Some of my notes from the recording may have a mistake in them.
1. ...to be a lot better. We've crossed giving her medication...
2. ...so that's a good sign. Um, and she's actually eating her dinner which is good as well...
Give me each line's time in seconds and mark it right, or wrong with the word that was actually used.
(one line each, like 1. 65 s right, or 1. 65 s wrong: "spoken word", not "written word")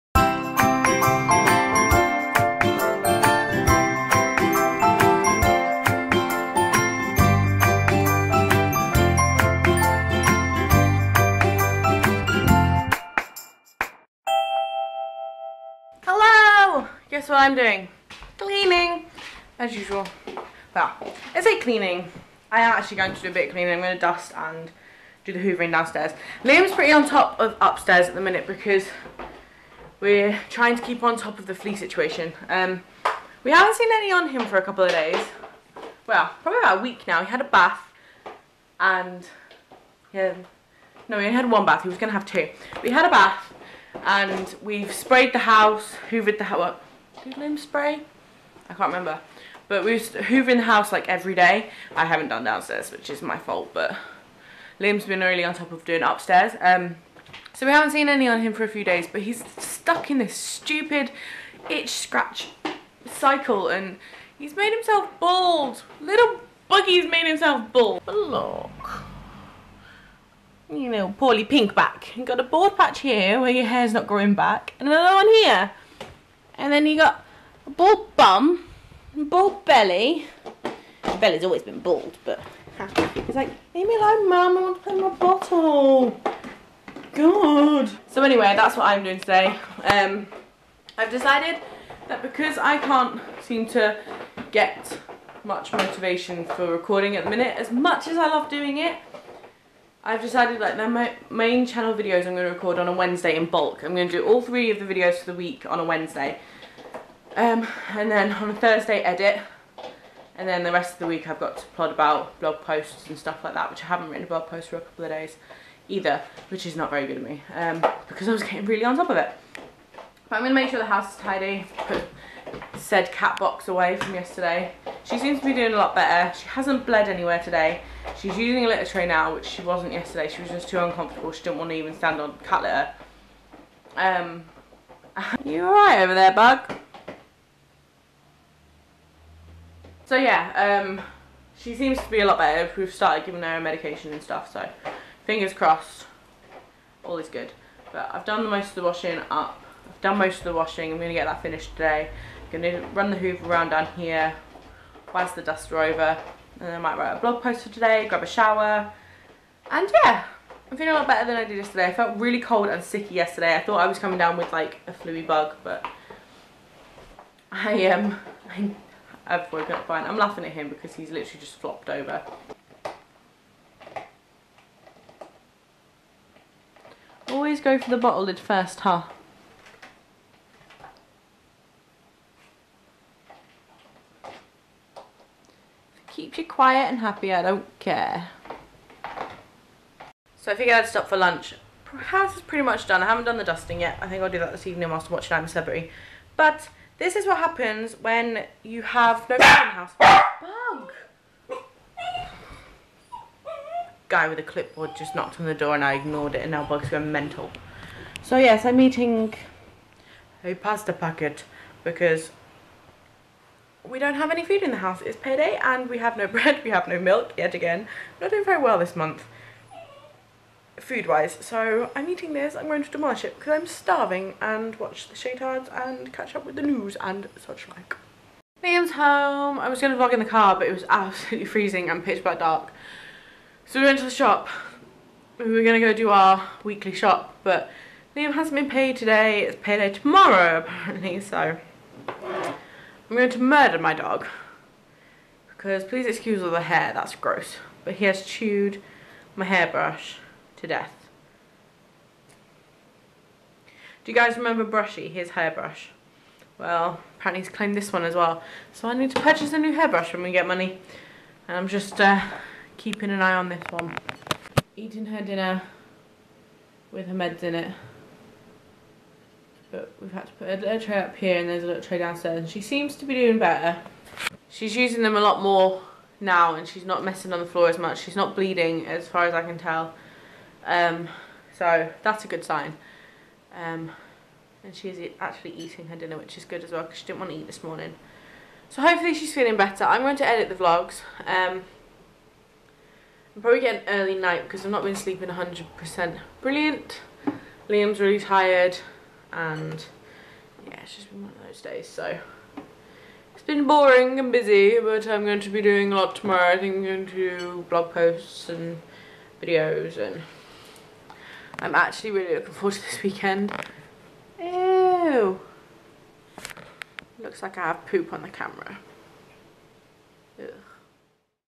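1. 141 s wrong: "started", not "crossed"
2. 281 s right.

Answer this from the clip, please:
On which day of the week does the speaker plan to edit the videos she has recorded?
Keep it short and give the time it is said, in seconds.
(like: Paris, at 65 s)
Thursday, at 108 s.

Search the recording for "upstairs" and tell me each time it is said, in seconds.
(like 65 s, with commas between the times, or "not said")
27 s, 56 s.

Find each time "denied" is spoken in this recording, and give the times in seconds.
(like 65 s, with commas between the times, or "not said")
not said.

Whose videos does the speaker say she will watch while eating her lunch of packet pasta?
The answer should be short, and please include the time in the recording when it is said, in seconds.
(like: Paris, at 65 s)
The Shaytards, at 225 s.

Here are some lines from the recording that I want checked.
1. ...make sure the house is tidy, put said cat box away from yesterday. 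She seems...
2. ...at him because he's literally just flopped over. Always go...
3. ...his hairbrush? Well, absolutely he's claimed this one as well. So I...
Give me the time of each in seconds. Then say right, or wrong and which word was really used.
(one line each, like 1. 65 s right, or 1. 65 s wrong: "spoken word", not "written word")
1. 120 s right
2. 170 s right
3. 255 s wrong: "apparently", not "absolutely".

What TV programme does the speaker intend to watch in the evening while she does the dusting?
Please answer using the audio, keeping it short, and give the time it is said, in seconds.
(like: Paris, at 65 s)
I'm a Celebrity, at 195 s.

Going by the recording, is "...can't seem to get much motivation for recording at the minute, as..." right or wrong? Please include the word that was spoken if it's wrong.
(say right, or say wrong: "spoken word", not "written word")
right.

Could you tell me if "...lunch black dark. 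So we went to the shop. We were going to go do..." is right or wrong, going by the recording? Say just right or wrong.
wrong.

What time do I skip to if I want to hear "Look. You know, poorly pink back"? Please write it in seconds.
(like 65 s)
68 s.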